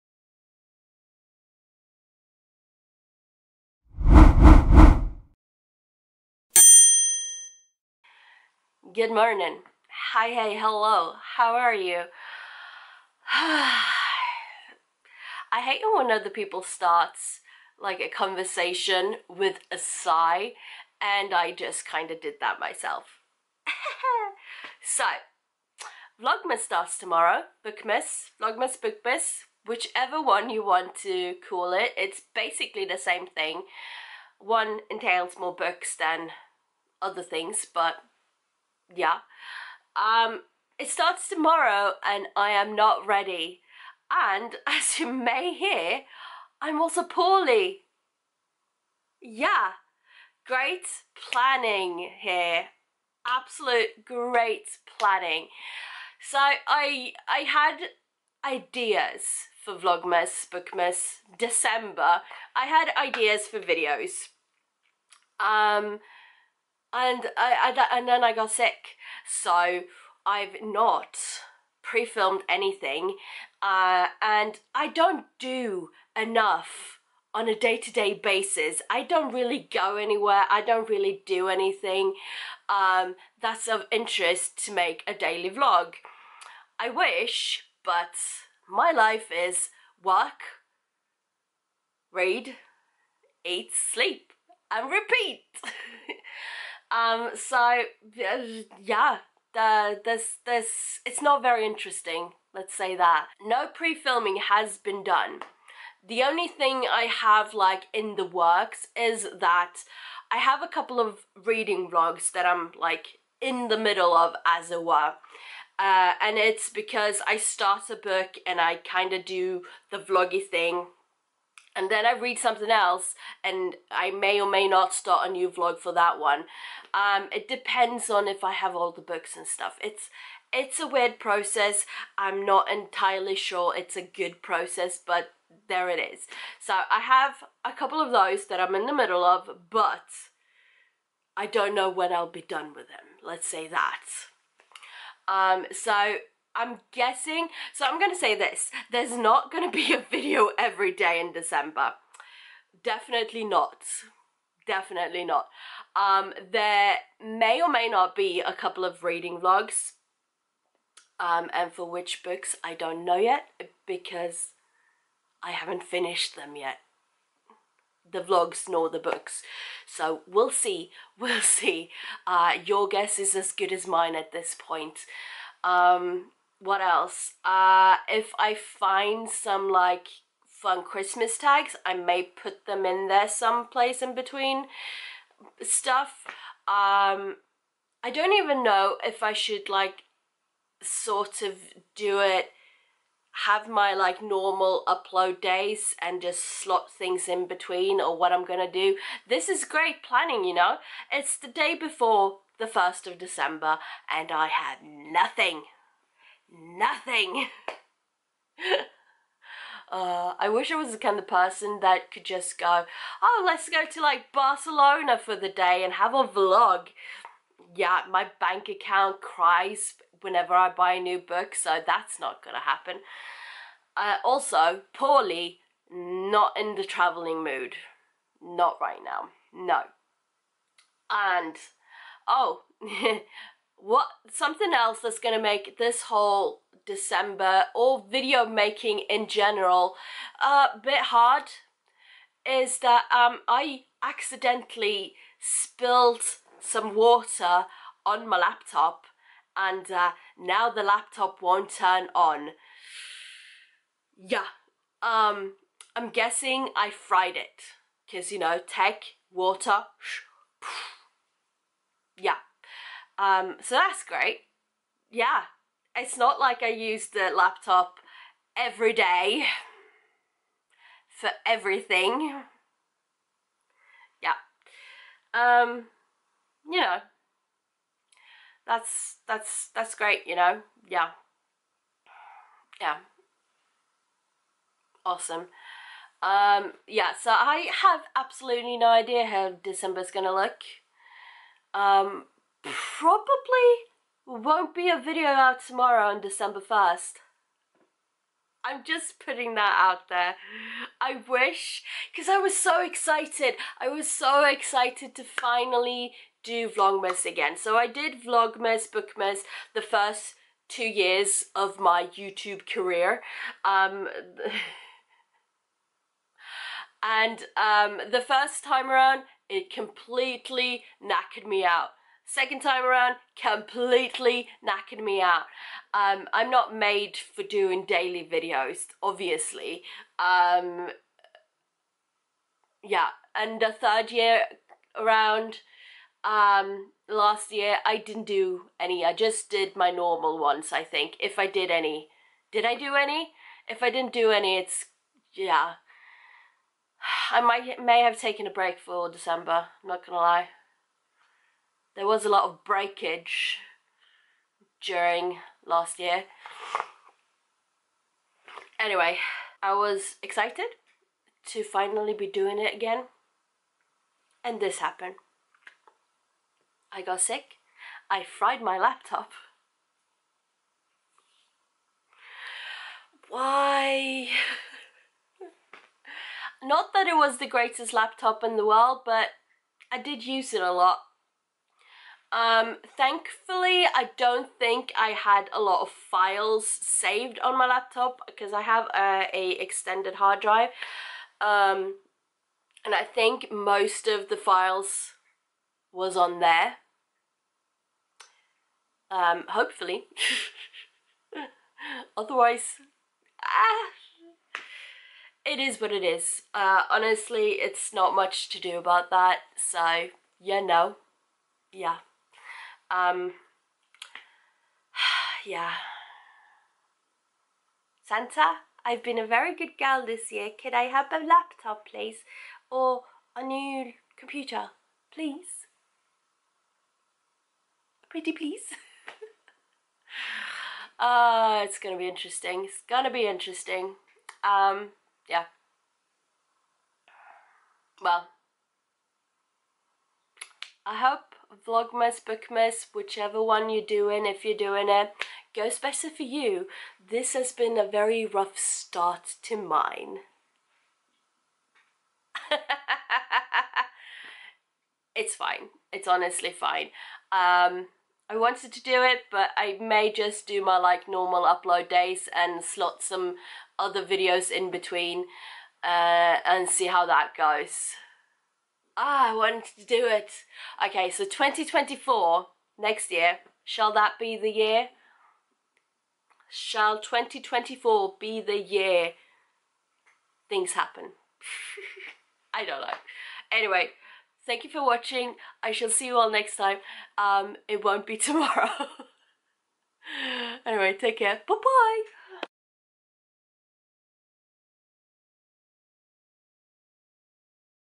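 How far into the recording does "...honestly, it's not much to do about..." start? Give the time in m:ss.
6:46.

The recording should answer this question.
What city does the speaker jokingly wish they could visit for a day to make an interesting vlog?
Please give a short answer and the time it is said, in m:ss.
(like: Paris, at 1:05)
Barcelona, at 3:34.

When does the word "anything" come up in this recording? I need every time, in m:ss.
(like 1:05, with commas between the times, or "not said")
1:12, 1:21.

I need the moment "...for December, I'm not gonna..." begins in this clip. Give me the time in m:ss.
5:48.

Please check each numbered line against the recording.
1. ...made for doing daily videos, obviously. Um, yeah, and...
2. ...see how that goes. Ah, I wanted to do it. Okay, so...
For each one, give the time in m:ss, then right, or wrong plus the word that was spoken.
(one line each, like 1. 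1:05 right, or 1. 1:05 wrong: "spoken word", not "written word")
1. 5:26 right
2. 7:46 right.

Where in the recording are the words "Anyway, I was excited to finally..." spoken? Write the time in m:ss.
5:58.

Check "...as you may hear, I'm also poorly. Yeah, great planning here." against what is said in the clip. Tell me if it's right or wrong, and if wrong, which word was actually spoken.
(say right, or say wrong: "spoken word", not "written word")
right.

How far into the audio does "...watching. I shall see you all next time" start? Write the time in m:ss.
8:04.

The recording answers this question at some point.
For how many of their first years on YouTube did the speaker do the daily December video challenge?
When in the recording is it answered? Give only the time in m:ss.
5:09.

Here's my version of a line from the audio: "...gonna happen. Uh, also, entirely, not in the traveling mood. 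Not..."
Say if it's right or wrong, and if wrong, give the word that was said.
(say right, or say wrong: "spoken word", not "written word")
wrong: "poorly", not "entirely".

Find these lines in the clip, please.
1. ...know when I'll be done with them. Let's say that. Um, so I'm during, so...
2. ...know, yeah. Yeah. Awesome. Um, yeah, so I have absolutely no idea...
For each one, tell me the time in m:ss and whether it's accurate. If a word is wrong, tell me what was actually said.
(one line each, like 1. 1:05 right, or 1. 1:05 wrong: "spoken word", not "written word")
1. 2:21 wrong: "guessing", not "during"
2. 4:40 right.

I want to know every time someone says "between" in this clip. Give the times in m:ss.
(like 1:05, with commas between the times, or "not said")
3:04, 3:17, 7:44.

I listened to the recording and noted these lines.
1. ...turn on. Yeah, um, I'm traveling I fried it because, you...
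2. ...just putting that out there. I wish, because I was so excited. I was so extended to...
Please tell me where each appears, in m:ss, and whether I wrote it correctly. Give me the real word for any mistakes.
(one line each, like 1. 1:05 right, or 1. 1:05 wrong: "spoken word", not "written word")
1. 4:11 wrong: "guessing", not "traveling"
2. 4:58 wrong: "excited", not "extended".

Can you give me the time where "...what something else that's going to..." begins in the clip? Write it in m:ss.
3:53.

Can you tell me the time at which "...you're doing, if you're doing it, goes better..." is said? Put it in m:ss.
7:23.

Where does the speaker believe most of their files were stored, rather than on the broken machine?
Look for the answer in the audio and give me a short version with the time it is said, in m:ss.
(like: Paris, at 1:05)
extended hard drive, at 6:29.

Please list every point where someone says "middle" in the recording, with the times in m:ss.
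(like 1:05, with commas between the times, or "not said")
1:53, 2:18.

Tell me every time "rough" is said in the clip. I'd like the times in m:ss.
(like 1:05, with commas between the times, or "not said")
7:28.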